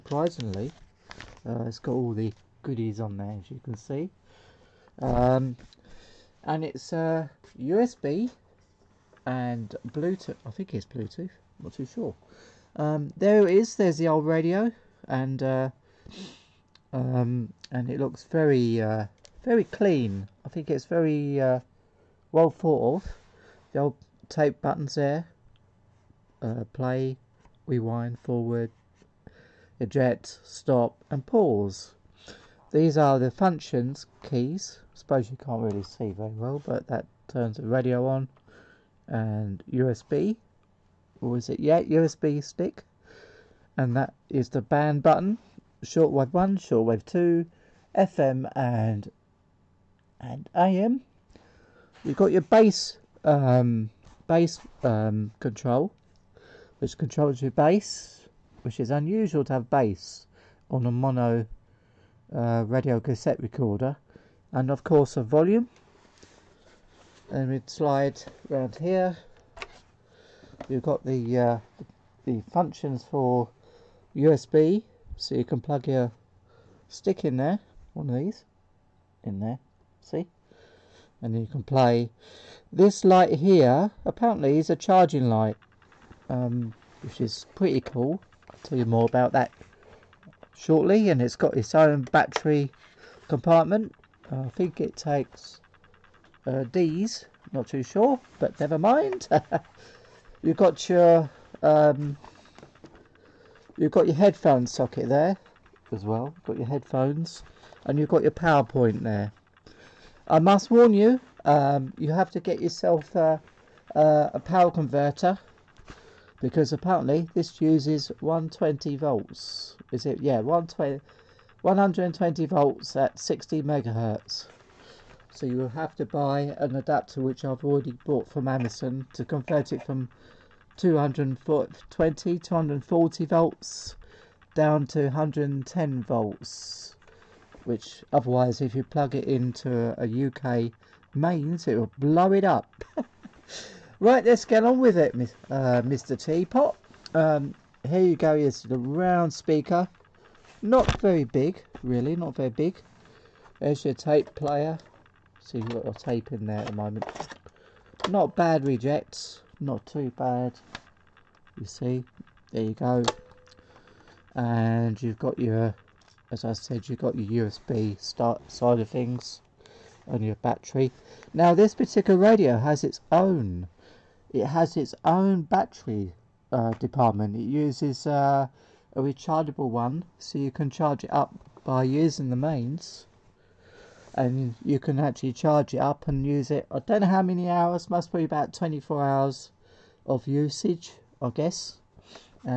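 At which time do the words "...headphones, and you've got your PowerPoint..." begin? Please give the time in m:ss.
1:46.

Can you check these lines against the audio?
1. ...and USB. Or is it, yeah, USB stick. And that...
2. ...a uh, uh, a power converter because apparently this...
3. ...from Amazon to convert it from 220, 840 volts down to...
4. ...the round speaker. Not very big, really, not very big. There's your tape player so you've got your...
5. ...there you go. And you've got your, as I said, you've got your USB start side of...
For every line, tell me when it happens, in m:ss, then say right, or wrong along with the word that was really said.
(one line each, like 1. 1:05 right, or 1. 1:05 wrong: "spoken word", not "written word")
1. 0:39 right
2. 1:53 right
3. 2:08 wrong: "240", not "840"
4. 2:28 right
5. 2:42 right.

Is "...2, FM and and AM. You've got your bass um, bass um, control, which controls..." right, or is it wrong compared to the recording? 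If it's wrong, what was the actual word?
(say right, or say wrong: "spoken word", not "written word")
right.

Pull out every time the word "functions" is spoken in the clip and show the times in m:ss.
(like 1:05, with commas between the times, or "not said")
0:33, 1:12.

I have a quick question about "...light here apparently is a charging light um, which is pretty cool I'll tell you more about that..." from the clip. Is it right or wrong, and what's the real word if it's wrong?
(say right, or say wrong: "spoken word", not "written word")
right.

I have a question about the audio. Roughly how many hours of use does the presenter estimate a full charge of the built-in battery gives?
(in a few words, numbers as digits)
24 hours.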